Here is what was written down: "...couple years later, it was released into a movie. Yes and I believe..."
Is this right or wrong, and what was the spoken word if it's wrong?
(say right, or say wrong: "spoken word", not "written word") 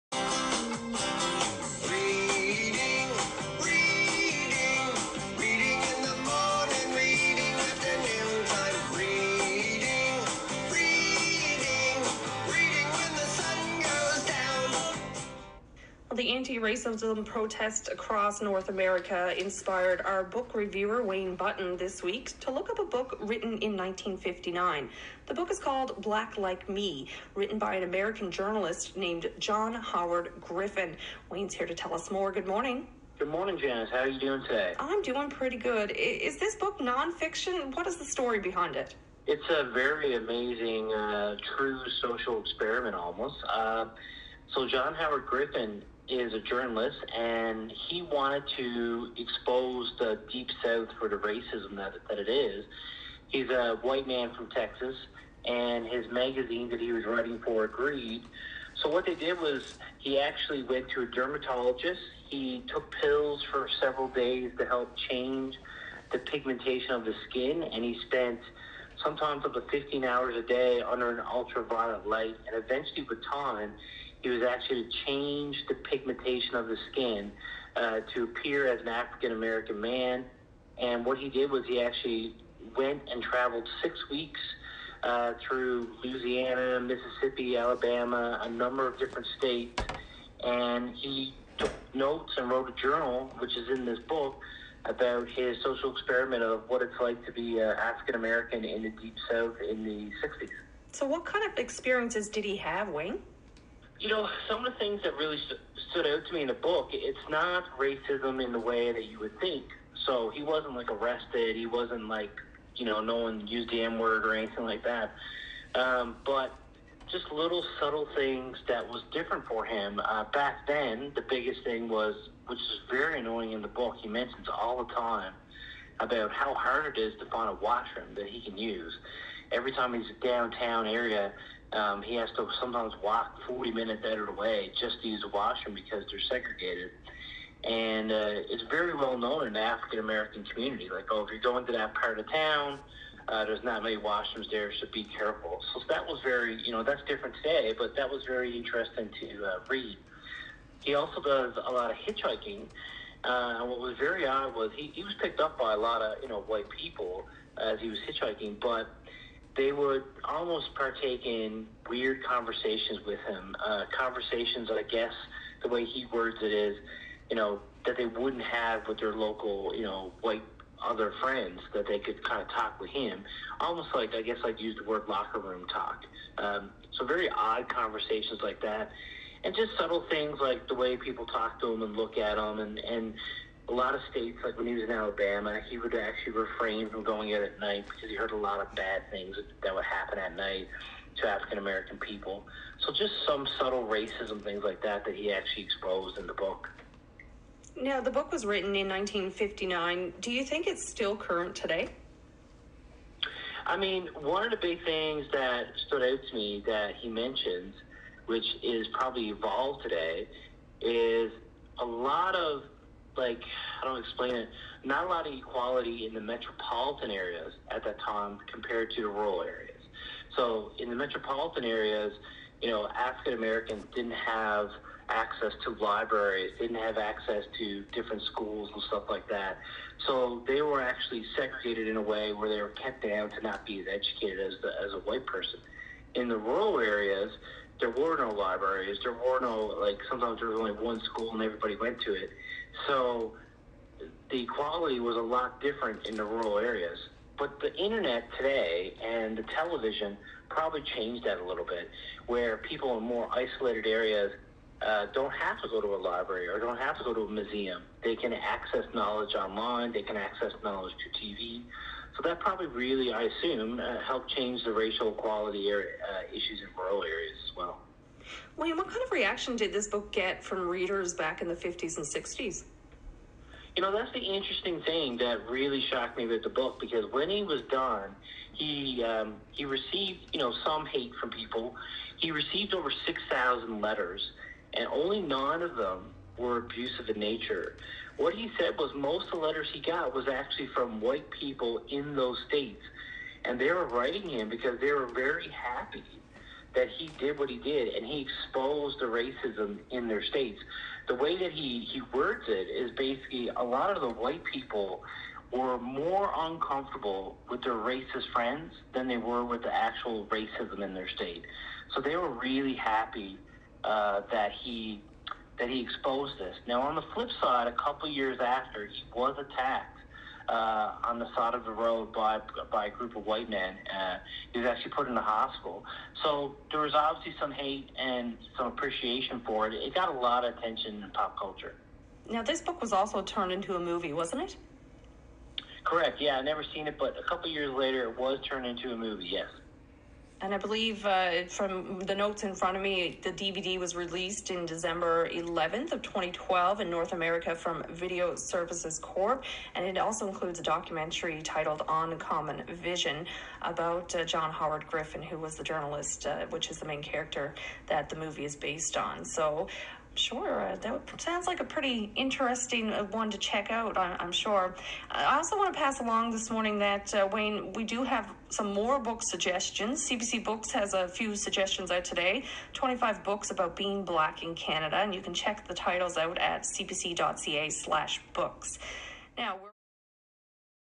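wrong: "turned", not "released".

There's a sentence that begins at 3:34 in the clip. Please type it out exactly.
Not a lot of equality in the metropolitan areas at that time compared to the rural areas.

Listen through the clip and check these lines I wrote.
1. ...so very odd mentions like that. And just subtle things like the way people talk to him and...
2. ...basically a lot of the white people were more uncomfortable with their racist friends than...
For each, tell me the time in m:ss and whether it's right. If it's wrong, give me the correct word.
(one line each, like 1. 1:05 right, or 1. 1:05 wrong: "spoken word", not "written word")
1. 2:56 wrong: "conversations", not "mentions"
2. 5:02 right.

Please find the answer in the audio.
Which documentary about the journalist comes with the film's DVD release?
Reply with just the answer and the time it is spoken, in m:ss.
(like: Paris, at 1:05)
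Uncommon Vision, at 5:51.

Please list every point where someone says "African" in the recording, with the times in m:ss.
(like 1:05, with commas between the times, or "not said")
1:18, 1:37, 2:19, 3:11, 3:42.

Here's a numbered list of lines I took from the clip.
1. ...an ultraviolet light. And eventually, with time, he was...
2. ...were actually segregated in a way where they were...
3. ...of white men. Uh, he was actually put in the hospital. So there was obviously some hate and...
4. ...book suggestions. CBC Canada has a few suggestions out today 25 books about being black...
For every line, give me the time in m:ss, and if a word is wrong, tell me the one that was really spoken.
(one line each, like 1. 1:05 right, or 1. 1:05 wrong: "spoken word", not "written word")
1. 1:11 right
2. 3:50 right
3. 5:23 right
4. 6:08 wrong: "Books", not "Canada".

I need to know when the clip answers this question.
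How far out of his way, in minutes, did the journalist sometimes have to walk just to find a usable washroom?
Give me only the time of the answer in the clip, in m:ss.
2:13.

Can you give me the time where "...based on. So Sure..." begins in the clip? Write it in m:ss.
5:58.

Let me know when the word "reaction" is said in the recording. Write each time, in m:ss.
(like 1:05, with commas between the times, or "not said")
4:29.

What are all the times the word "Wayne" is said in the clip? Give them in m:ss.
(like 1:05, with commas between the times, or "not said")
0:21, 0:31, 1:42, 6:07.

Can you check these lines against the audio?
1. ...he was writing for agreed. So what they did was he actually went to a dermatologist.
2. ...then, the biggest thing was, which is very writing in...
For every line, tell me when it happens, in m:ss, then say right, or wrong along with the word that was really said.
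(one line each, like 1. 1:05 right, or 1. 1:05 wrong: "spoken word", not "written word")
1. 0:56 right
2. 2:00 wrong: "annoying", not "writing".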